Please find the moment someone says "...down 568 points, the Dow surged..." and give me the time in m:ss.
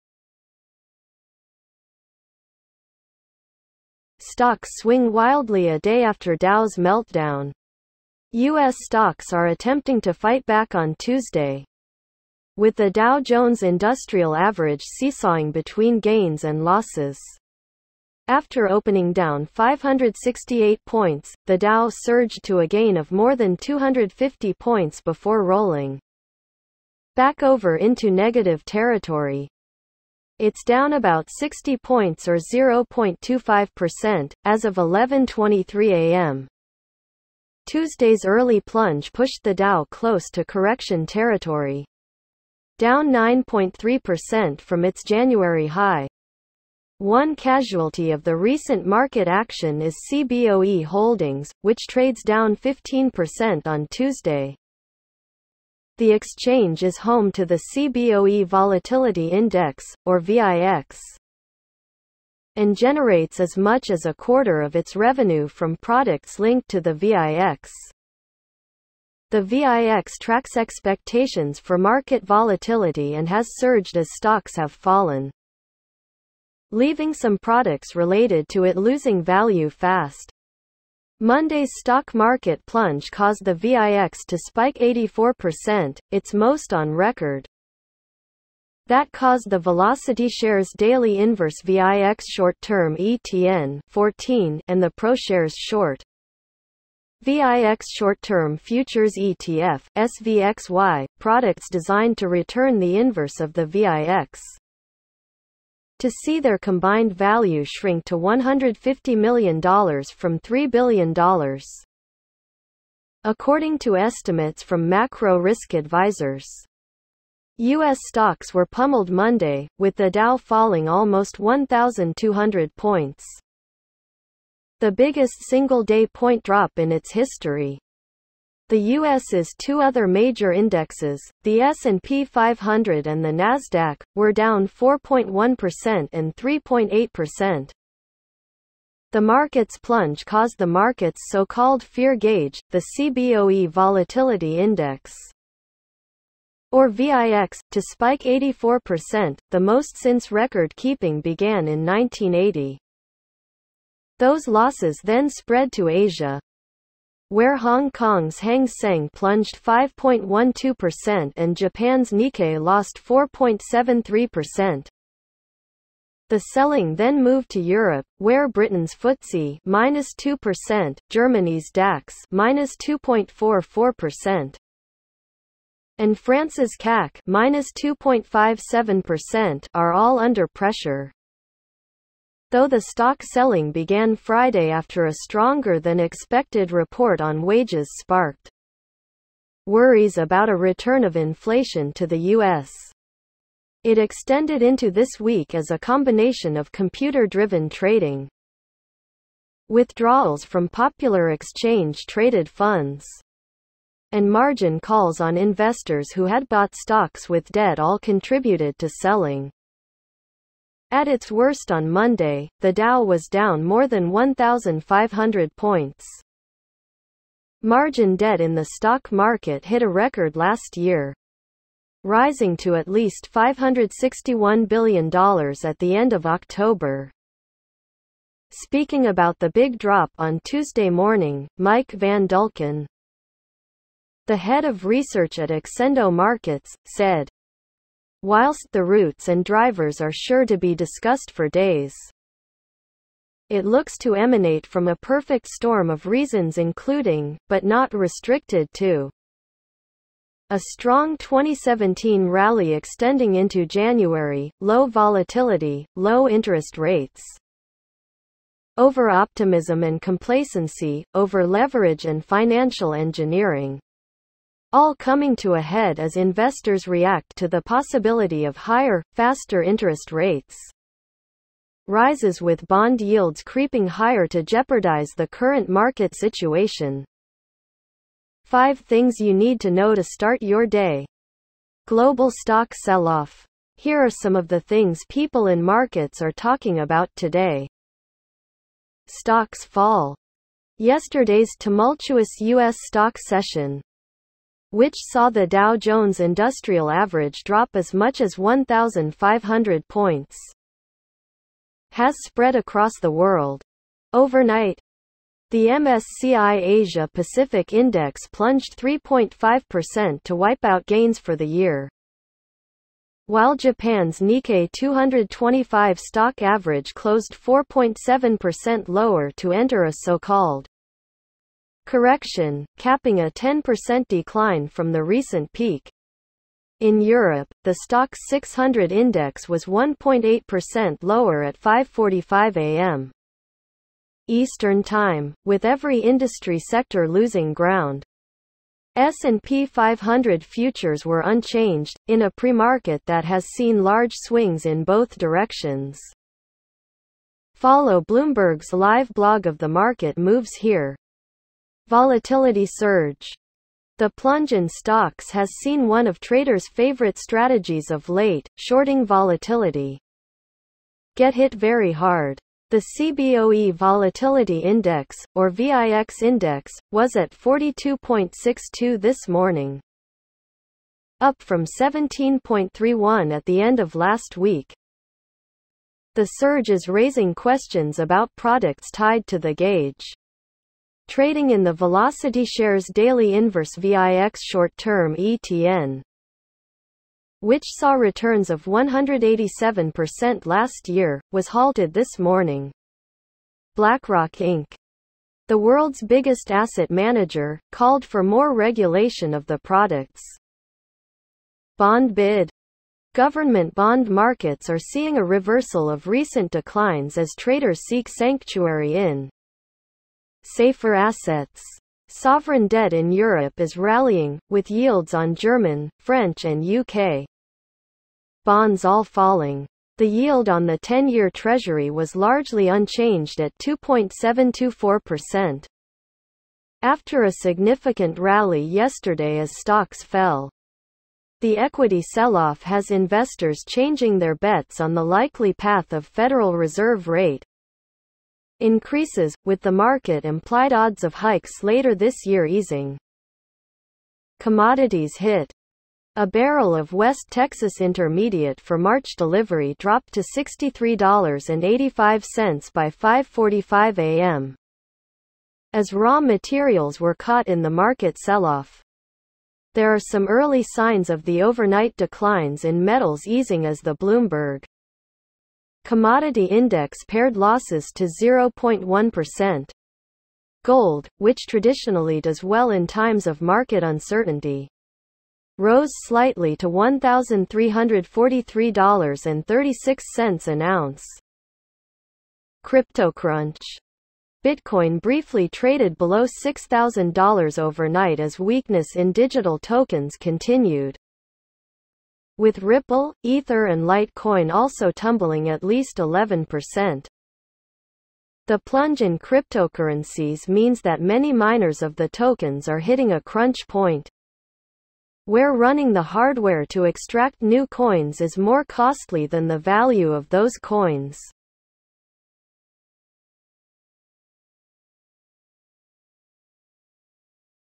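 0:19.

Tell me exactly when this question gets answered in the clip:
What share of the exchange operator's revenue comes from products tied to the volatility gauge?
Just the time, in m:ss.
1:04.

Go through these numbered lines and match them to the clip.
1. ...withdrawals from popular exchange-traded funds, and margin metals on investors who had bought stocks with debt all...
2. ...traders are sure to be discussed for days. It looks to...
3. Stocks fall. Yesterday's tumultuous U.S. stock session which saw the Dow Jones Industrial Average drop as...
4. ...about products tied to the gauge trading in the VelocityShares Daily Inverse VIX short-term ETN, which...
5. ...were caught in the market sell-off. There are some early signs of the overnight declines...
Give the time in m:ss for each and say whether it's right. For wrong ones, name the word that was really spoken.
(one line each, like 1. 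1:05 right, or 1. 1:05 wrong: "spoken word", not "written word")
1. 3:19 wrong: "calls", not "metals"
2. 3:59 wrong: "drivers", not "traders"
3. 4:49 right
4. 6:17 right
5. 7:36 right.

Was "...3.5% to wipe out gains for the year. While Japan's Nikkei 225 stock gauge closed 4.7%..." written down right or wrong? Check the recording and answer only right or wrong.
wrong.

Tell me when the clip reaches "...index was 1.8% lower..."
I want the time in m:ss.
5:28.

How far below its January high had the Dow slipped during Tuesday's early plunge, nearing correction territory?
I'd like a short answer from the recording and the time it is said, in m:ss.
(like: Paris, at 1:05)
9.3%, at 0:43.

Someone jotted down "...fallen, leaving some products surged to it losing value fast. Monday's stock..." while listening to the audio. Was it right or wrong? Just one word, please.
wrong.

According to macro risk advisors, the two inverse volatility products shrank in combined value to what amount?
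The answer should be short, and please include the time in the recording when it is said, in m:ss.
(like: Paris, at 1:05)
$150 million, at 1:48.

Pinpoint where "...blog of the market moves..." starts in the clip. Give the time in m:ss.
5:49.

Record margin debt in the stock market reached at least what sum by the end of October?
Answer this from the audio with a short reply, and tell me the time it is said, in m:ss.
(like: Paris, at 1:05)
$561 billion, at 3:43.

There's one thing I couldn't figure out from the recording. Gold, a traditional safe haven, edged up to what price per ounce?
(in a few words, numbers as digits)
$1,343.36.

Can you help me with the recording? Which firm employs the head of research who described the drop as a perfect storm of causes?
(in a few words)
Accendo Markets.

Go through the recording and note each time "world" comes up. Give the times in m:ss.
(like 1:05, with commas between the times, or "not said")
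5:03, 6:35.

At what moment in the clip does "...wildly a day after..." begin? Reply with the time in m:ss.
0:05.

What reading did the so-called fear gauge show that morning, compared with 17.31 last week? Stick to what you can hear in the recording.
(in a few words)
42.62.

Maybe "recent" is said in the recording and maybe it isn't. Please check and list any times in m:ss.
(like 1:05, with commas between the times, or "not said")
0:48, 5:25, 6:46.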